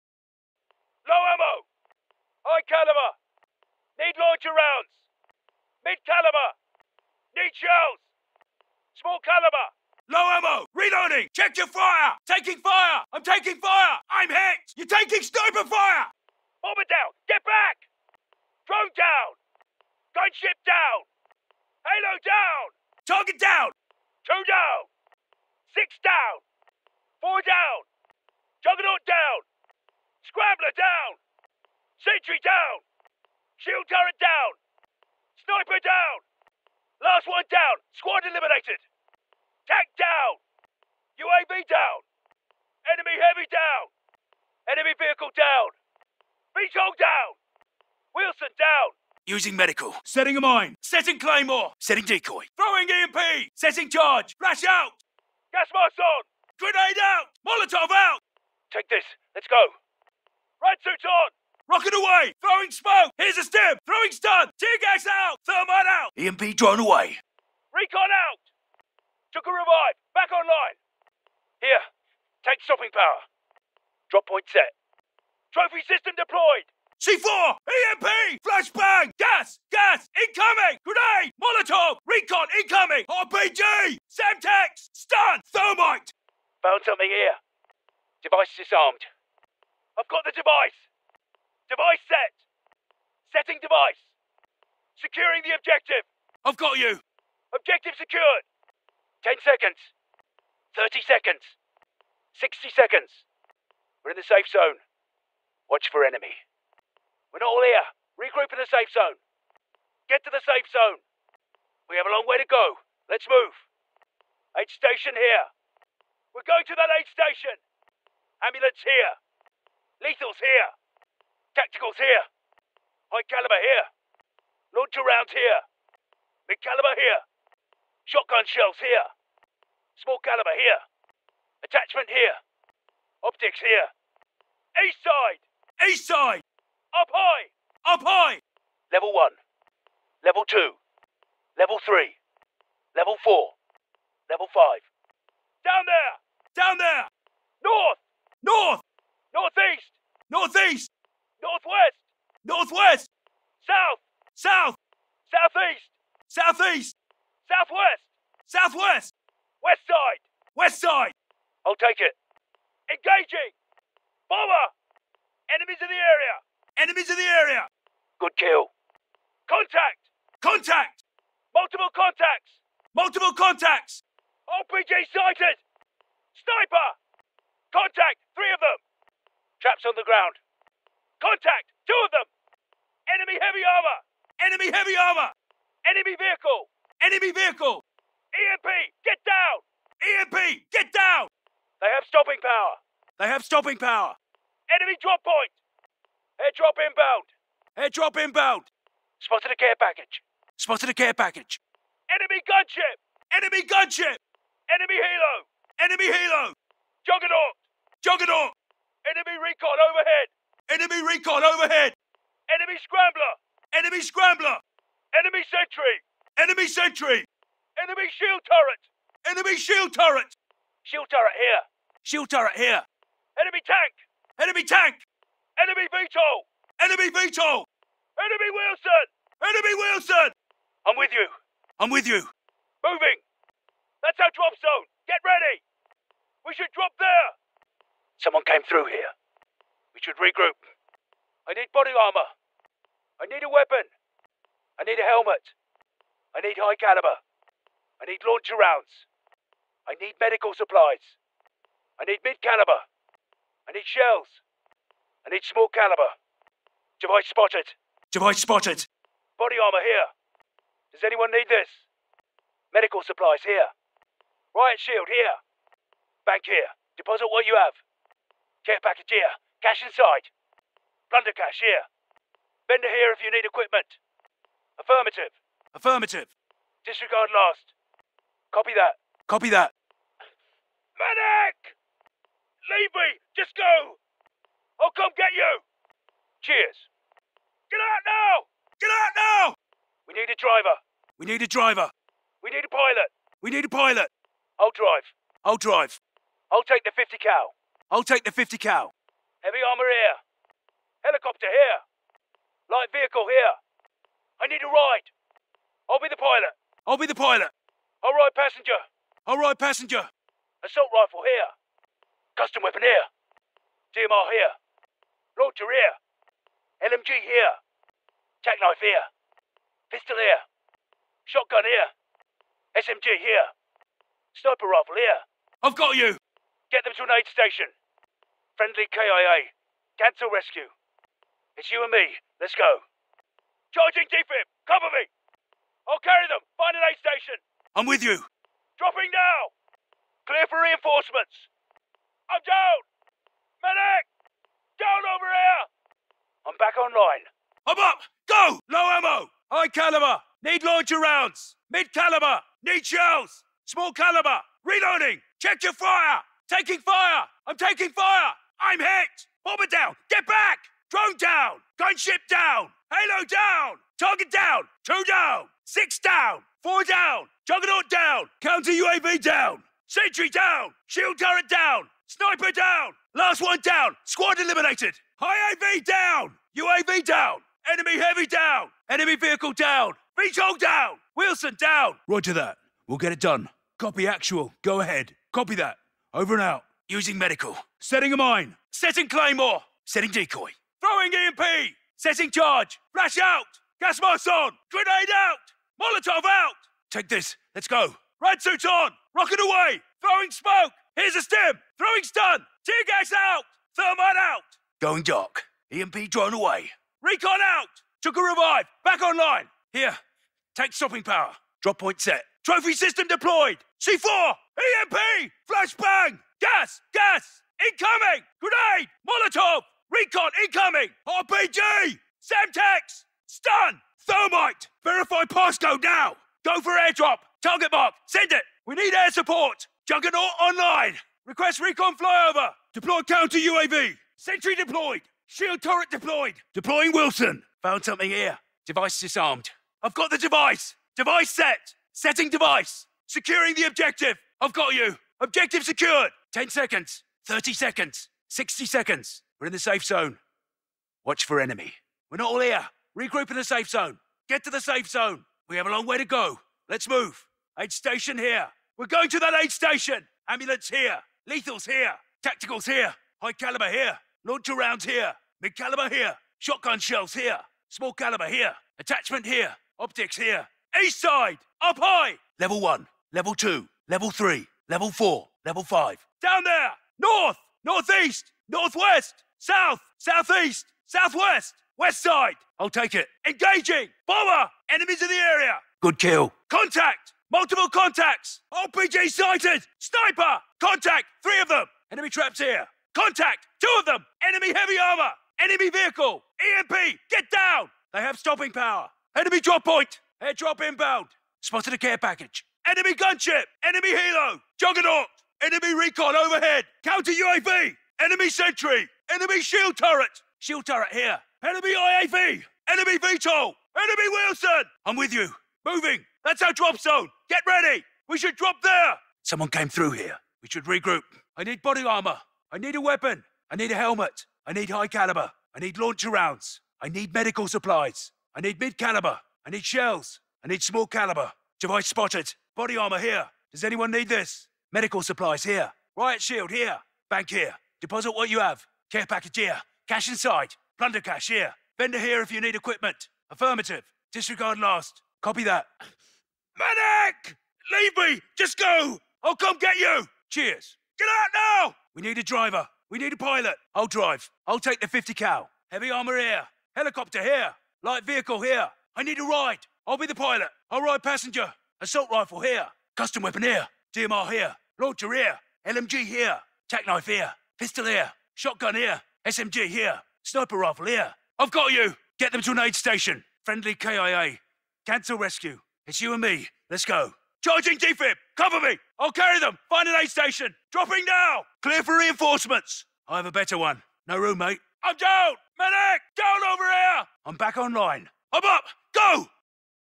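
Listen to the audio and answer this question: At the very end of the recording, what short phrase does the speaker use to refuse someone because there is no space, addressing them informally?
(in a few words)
No room, mate.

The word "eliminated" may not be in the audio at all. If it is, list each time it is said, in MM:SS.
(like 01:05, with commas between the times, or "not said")
00:38, 06:14.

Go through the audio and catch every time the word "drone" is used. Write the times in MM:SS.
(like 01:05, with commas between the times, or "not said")
00:18, 01:06, 06:00, 06:46.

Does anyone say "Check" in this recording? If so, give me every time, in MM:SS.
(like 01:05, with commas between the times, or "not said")
00:11, 05:55.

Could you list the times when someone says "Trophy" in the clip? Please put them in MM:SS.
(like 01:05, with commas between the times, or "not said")
01:15, 06:52.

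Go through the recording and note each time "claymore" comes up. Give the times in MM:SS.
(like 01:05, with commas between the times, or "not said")
00:51, 06:29.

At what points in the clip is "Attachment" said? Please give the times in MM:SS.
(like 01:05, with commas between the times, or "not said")
02:11, 07:48.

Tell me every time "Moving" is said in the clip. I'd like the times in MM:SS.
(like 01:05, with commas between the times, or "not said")
03:52, 08:35.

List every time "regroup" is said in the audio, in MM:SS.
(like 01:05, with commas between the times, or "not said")
01:48, 04:00, 07:32, 08:40.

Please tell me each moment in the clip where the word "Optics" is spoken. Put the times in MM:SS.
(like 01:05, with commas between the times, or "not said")
02:13, 07:49.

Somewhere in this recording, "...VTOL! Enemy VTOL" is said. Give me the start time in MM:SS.
03:45.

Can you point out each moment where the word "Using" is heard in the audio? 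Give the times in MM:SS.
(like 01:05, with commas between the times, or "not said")
00:49, 06:26.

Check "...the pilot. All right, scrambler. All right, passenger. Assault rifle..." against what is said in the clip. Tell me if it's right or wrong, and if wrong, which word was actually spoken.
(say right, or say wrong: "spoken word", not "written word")
wrong: "passenger", not "scrambler".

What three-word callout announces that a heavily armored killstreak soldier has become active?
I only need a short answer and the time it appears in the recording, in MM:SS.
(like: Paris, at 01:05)
Juggernaut online, at 07:09.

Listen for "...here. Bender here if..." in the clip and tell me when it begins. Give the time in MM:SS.
04:31.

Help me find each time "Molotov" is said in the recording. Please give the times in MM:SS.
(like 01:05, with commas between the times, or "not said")
00:57, 01:21, 06:35, 06:59.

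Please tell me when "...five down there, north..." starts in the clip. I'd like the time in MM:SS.
07:55.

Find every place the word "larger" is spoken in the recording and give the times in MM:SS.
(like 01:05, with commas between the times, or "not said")
05:50.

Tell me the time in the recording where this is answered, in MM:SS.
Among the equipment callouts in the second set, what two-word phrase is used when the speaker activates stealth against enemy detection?
06:44.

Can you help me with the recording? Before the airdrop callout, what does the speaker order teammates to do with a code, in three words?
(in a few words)
Verify passcode now.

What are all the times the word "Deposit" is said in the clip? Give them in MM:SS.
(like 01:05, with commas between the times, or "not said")
04:26, 08:57.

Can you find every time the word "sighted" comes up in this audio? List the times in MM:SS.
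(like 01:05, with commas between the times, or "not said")
02:55, 08:09.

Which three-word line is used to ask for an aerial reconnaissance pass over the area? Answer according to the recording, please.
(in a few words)
Request recon flyover.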